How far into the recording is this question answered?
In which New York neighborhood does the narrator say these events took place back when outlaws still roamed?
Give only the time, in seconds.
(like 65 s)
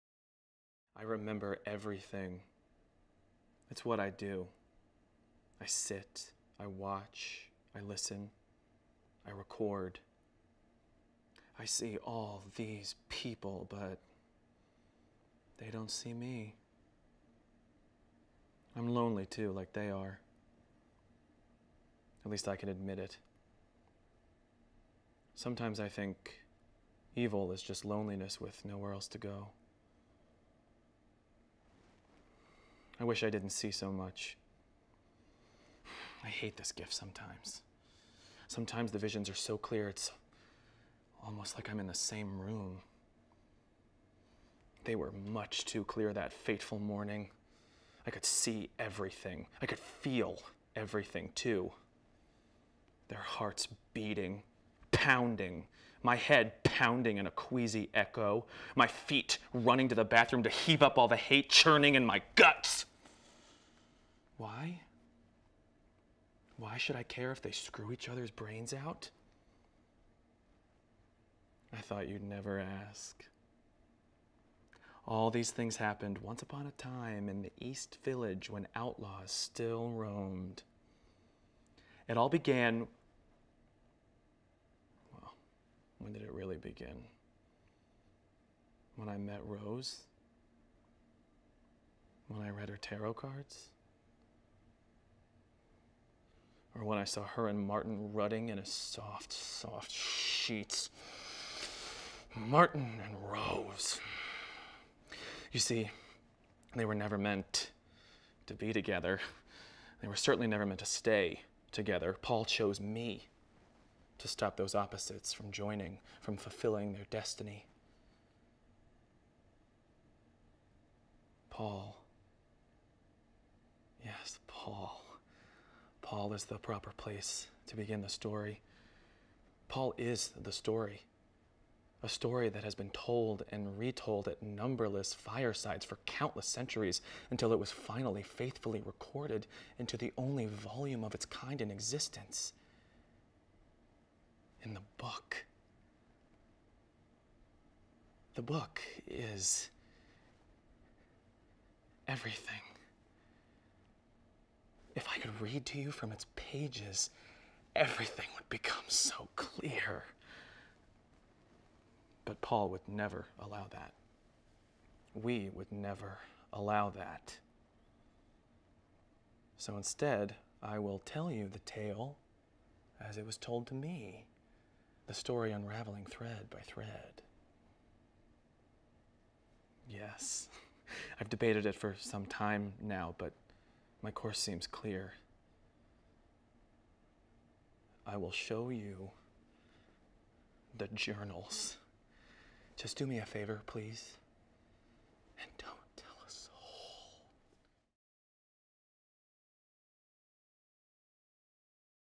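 77 s.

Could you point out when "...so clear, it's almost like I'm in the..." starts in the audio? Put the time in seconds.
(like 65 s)
39 s.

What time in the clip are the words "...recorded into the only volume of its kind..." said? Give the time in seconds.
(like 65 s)
138 s.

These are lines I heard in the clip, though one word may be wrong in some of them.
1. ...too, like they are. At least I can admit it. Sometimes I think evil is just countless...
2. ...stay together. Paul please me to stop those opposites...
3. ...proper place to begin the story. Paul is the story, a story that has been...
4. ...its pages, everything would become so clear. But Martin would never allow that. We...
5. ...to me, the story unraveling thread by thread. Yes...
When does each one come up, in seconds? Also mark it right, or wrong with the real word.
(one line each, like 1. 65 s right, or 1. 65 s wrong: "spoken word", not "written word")
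1. 19 s wrong: "loneliness", not "countless"
2. 110 s wrong: "chose", not "please"
3. 126 s right
4. 156 s wrong: "Paul", not "Martin"
5. 173 s right.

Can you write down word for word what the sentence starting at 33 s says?
I wish I didn't see so much.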